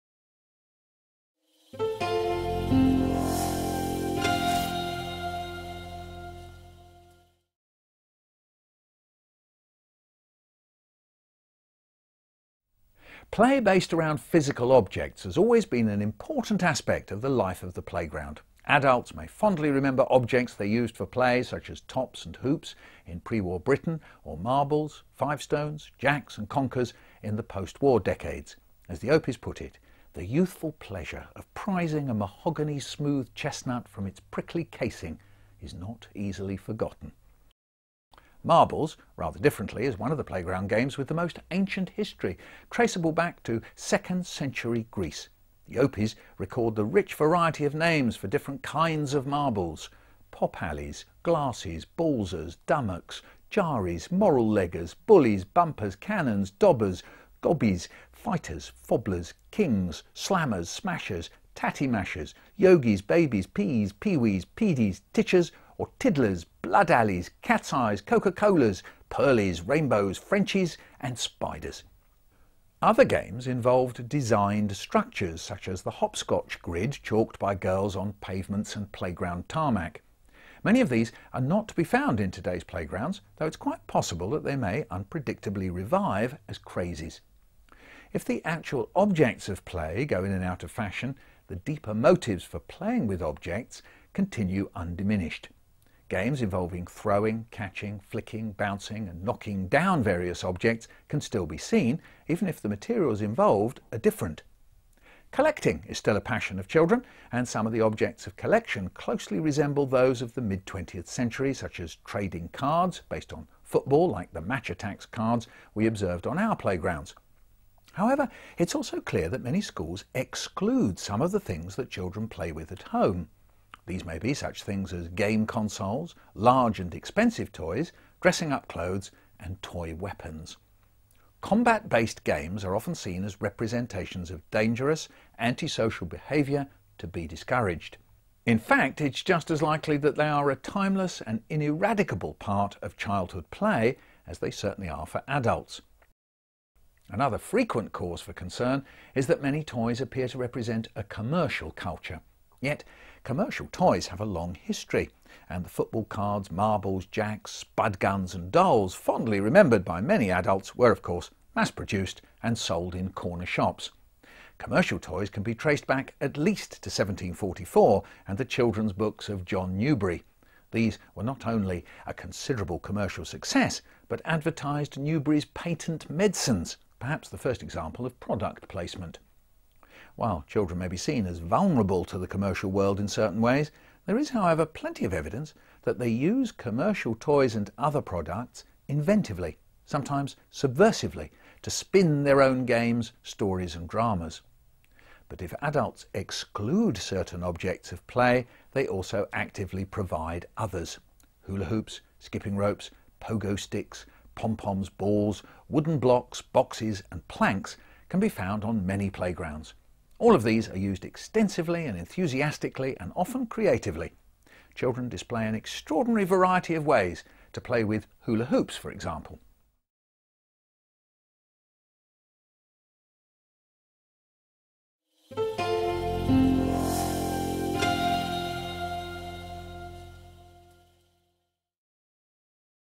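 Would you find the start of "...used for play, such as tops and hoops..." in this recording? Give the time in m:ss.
0:20.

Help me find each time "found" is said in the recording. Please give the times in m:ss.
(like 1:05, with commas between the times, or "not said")
1:21, 3:28.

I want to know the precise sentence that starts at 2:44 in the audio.
Commercial toys can be traced back at least to 1744 and the children's books of John Newbery.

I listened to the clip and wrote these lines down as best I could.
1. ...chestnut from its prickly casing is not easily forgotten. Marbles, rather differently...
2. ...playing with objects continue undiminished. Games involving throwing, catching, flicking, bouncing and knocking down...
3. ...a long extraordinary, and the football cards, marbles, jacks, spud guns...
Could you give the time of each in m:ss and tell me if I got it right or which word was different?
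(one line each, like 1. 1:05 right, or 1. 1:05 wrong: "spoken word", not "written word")
1. 0:33 right
2. 1:32 right
3. 2:34 wrong: "history", not "extraordinary".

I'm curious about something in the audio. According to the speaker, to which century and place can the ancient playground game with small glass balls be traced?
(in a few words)
2nd century Greece.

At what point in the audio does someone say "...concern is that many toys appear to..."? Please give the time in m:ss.
2:28.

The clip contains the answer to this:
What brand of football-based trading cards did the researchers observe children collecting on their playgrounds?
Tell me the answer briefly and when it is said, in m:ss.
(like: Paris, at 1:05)
Match Attax, at 1:54.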